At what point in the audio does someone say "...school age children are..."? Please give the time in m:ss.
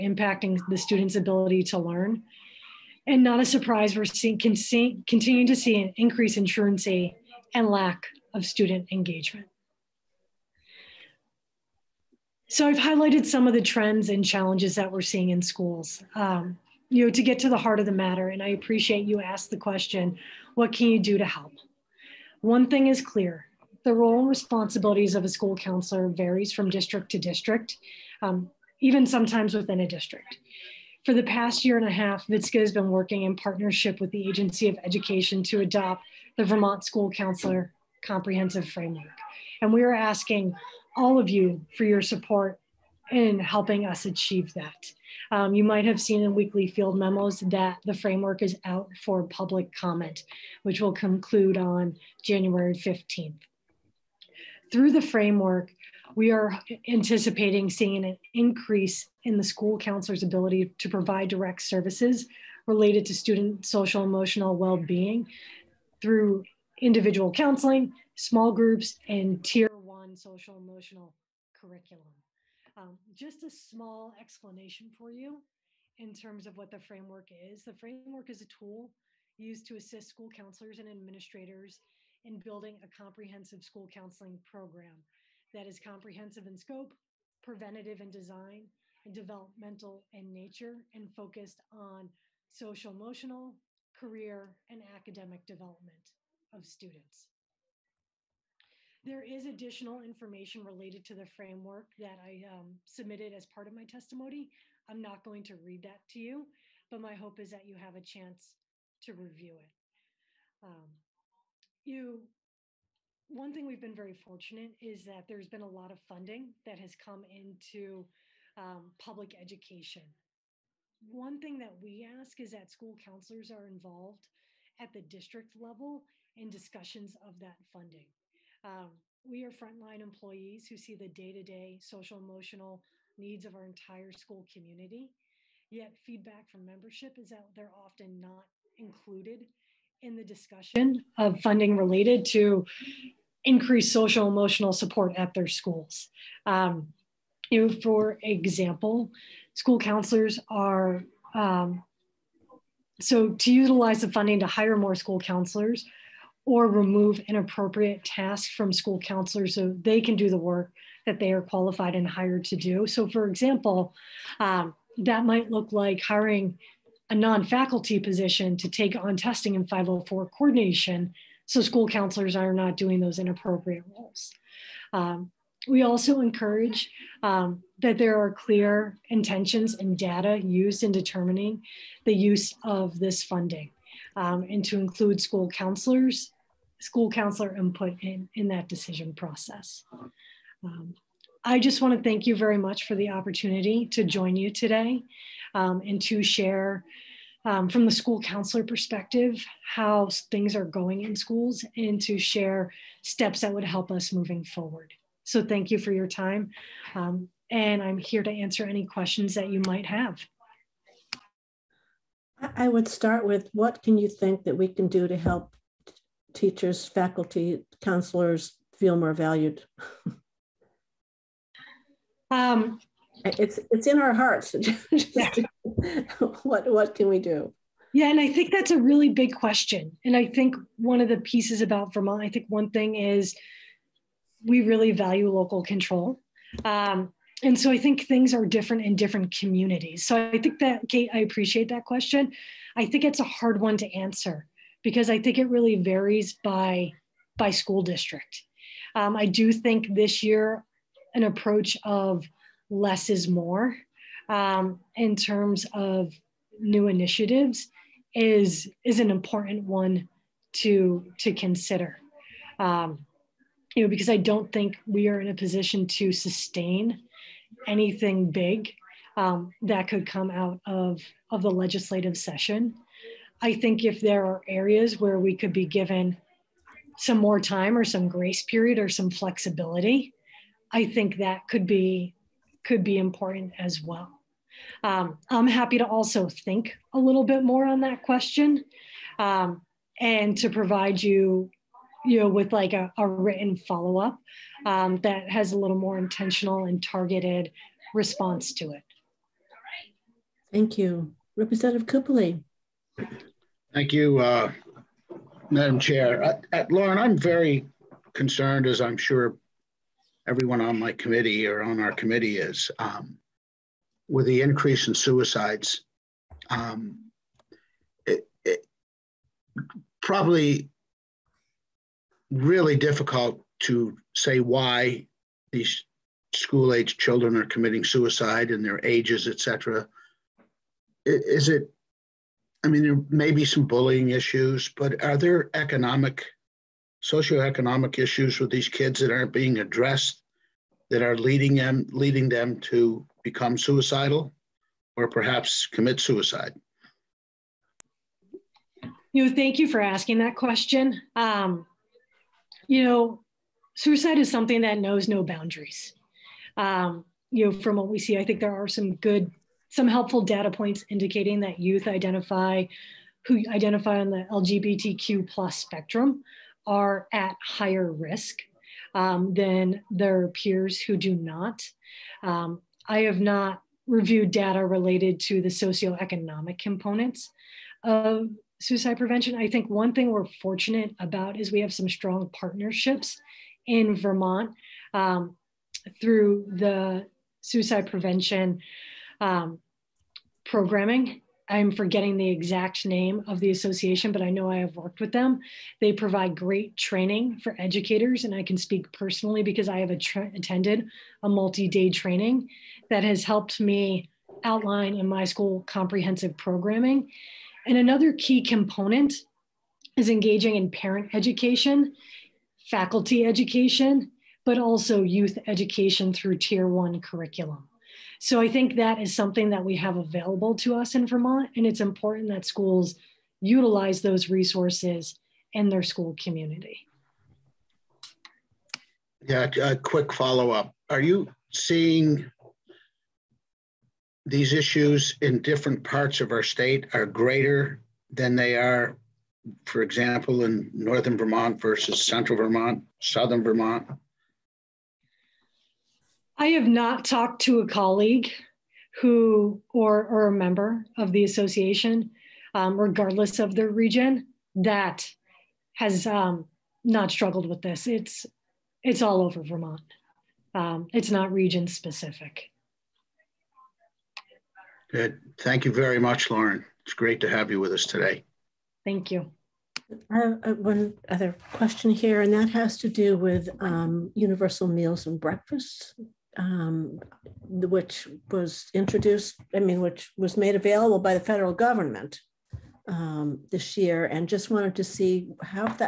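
5:26.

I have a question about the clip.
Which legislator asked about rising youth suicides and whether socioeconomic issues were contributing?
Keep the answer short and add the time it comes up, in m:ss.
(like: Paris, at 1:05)
Representative Cupoli, at 5:01.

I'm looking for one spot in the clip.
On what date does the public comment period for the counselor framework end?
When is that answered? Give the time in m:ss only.
0:52.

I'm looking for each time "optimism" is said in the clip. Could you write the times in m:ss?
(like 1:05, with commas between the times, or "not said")
not said.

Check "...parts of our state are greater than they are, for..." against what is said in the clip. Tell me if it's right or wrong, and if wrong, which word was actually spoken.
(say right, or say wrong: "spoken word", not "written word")
right.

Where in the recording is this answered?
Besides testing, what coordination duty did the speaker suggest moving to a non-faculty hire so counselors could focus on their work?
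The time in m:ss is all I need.
2:49.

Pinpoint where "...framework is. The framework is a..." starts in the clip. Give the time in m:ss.
1:16.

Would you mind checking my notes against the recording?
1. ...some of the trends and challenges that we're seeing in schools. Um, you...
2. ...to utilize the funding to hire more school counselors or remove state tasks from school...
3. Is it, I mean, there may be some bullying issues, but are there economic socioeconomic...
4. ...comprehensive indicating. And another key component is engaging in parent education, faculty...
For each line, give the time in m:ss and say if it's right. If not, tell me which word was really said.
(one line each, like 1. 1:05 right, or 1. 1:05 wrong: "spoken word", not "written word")
1. 0:13 right
2. 2:33 wrong: "inappropriate", not "state"
3. 5:31 right
4. 6:45 wrong: "programming", not "indicating".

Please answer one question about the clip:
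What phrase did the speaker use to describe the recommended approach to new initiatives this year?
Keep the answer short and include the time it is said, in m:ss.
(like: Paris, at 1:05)
less is more, at 4:12.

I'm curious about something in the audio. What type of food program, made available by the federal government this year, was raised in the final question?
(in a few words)
universal meals.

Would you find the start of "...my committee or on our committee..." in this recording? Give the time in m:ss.
5:10.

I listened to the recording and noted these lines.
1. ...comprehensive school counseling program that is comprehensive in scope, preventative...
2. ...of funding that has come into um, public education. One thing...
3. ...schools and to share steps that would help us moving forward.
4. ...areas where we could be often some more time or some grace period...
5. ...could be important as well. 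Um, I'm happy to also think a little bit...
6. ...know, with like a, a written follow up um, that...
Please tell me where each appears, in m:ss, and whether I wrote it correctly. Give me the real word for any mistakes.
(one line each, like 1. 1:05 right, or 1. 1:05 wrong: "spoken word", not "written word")
1. 1:22 right
2. 1:55 right
3. 3:21 right
4. 4:34 wrong: "given", not "often"
5. 4:42 right
6. 4:52 right.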